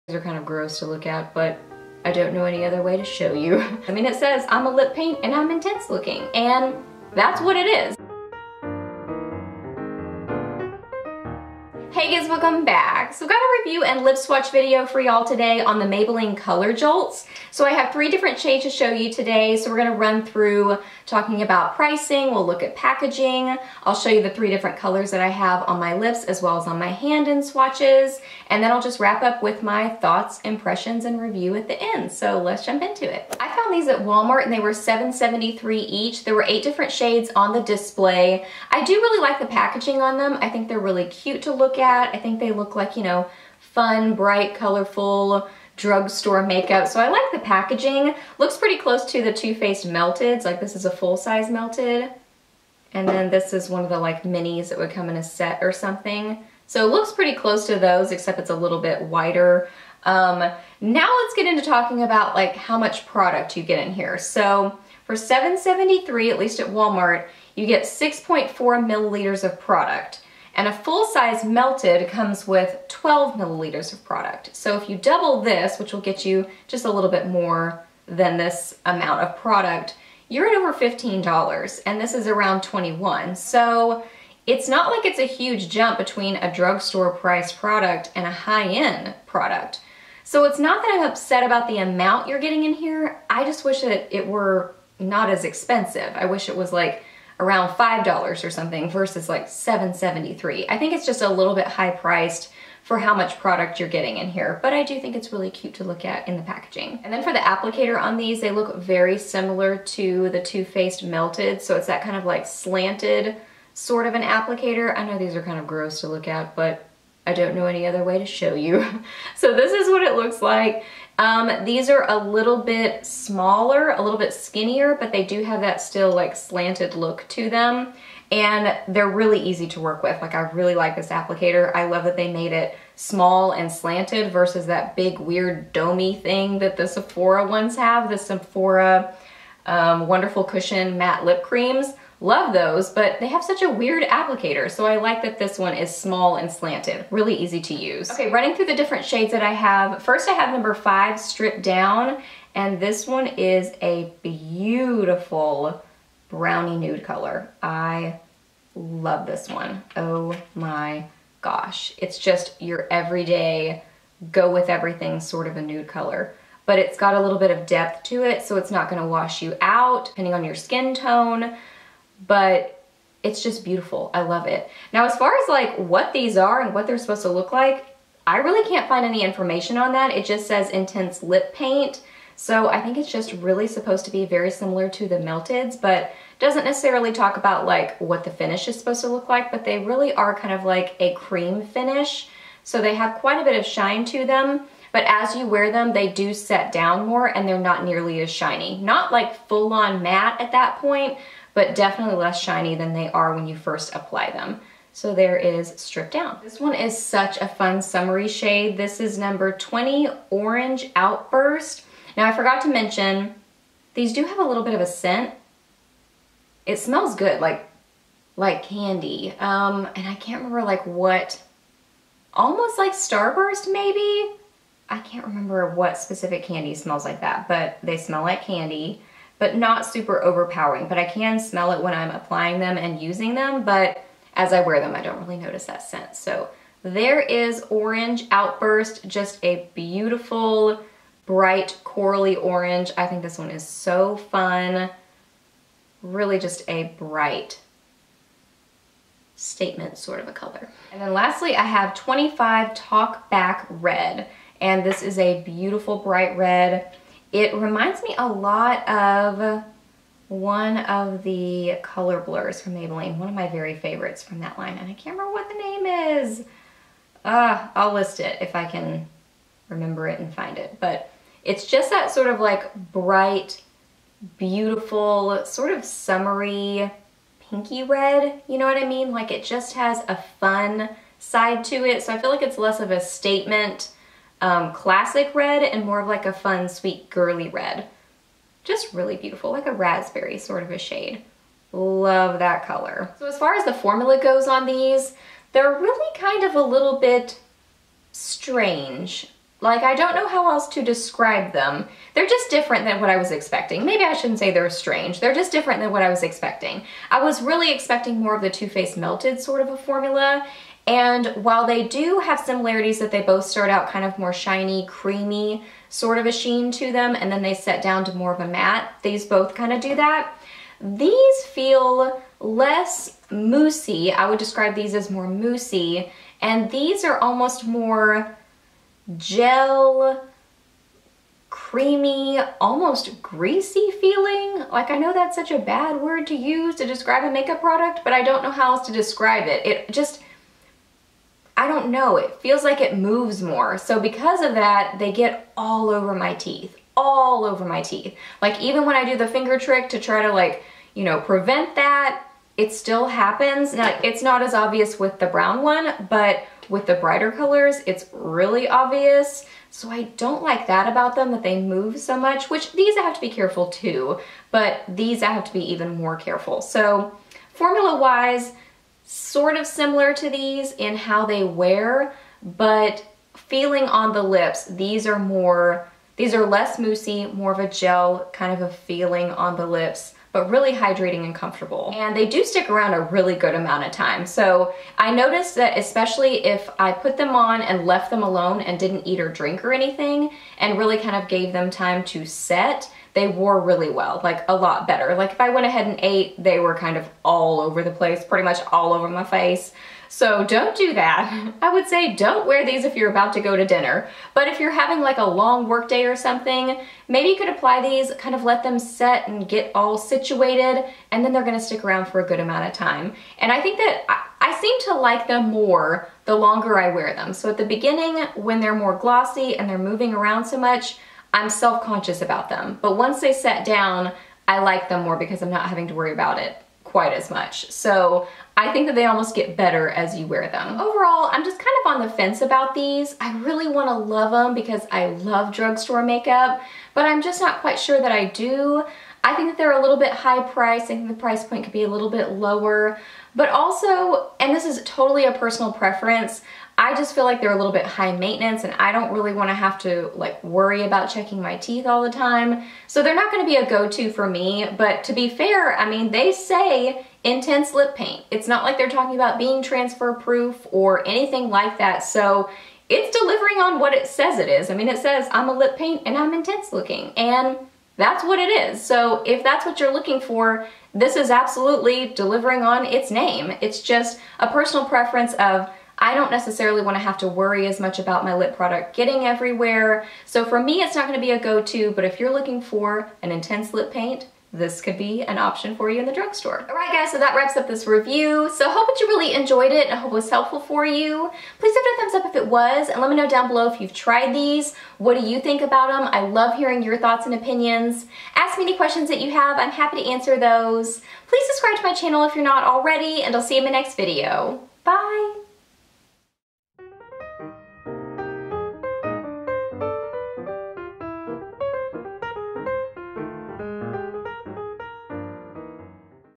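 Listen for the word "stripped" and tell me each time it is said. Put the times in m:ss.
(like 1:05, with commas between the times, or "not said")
2:31, 3:25.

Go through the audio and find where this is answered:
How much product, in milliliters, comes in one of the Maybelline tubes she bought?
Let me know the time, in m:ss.
1:07.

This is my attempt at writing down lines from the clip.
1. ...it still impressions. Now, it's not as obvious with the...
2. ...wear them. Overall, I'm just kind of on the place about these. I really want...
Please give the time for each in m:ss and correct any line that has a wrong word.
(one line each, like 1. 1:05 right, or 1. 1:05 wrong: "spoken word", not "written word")
1. 5:52 wrong: "happens", not "impressions"
2. 7:10 wrong: "fence", not "place".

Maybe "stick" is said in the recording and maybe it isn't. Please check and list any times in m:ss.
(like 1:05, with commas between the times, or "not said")
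6:22, 6:51.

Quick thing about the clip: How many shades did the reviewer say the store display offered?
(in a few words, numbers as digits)
8.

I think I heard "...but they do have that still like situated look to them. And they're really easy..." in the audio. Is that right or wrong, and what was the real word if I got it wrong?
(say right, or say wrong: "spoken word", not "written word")
wrong: "slanted", not "situated".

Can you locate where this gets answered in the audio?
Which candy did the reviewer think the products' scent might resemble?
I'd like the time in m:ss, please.
3:42.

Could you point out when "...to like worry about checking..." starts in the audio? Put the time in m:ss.
7:29.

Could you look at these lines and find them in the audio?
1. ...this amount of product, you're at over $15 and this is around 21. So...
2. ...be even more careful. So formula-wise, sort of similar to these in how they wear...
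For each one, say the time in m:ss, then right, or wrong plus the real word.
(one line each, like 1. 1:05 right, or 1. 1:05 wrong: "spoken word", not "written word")
1. 1:18 right
2. 6:05 right.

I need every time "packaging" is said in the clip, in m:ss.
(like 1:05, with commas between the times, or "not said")
0:22, 0:39, 0:47, 1:46.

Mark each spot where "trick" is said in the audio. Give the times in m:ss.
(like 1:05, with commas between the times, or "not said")
5:49.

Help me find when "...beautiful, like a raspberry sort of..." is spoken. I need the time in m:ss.
4:49.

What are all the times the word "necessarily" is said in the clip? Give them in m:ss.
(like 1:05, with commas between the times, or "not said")
3:06, 7:56.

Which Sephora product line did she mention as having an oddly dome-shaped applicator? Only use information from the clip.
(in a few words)
Wonderful Cushion Matte Lip Creams.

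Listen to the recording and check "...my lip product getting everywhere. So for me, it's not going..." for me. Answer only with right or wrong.
right.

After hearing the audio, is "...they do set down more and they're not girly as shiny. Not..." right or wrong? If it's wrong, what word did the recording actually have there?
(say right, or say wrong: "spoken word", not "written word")
wrong: "nearly", not "girly".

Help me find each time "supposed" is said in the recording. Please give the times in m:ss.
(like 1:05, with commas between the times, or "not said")
2:56, 3:03, 3:08.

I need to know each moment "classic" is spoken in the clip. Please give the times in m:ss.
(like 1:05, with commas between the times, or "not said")
4:44.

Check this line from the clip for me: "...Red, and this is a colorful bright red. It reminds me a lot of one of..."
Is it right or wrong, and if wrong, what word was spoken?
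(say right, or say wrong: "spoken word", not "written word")
wrong: "beautiful", not "colorful".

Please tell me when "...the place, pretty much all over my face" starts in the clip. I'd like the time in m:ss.
6:37.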